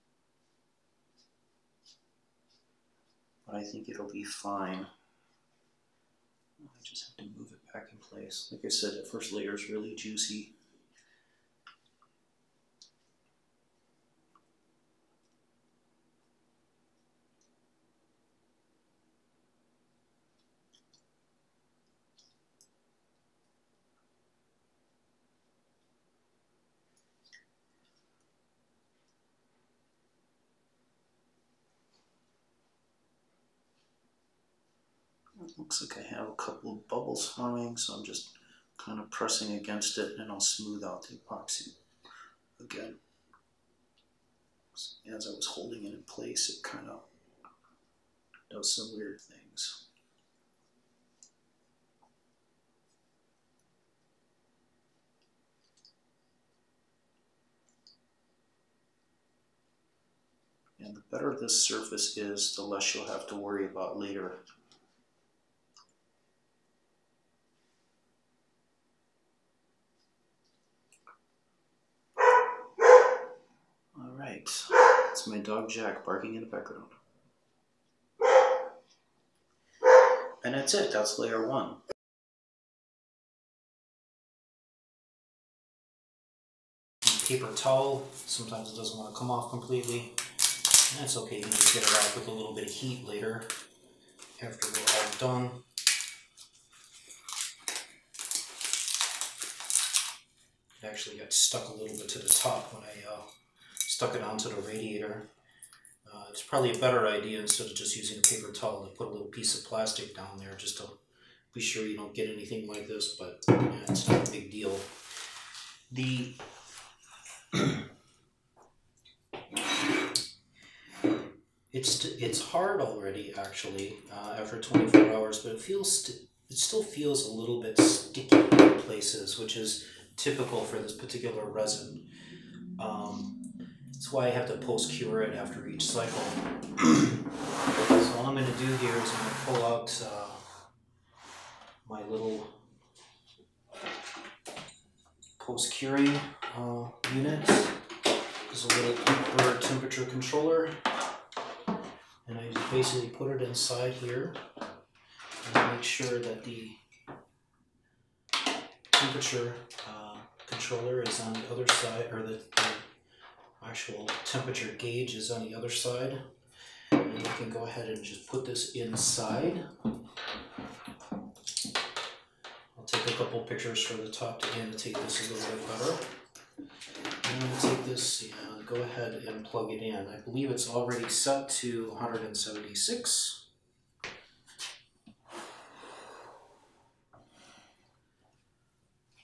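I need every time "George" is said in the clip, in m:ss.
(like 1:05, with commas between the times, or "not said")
not said.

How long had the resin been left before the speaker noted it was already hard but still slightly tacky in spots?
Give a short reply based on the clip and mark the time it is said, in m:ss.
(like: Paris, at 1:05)
24 hours, at 2:04.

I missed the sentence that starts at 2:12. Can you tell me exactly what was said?
Um, that's why I have to pulse cure it after each cycle.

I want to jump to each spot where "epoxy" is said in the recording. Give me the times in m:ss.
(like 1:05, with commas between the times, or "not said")
0:41.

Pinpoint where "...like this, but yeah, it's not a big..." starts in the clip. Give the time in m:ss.
1:52.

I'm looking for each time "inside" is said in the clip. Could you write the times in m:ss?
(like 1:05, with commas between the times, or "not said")
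2:33, 2:48.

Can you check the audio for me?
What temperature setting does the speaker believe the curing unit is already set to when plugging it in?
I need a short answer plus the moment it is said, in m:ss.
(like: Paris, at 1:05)
176, at 3:01.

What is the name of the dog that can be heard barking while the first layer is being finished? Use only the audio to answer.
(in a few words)
Jack.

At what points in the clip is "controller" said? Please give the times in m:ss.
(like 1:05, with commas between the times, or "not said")
2:30, 2:40.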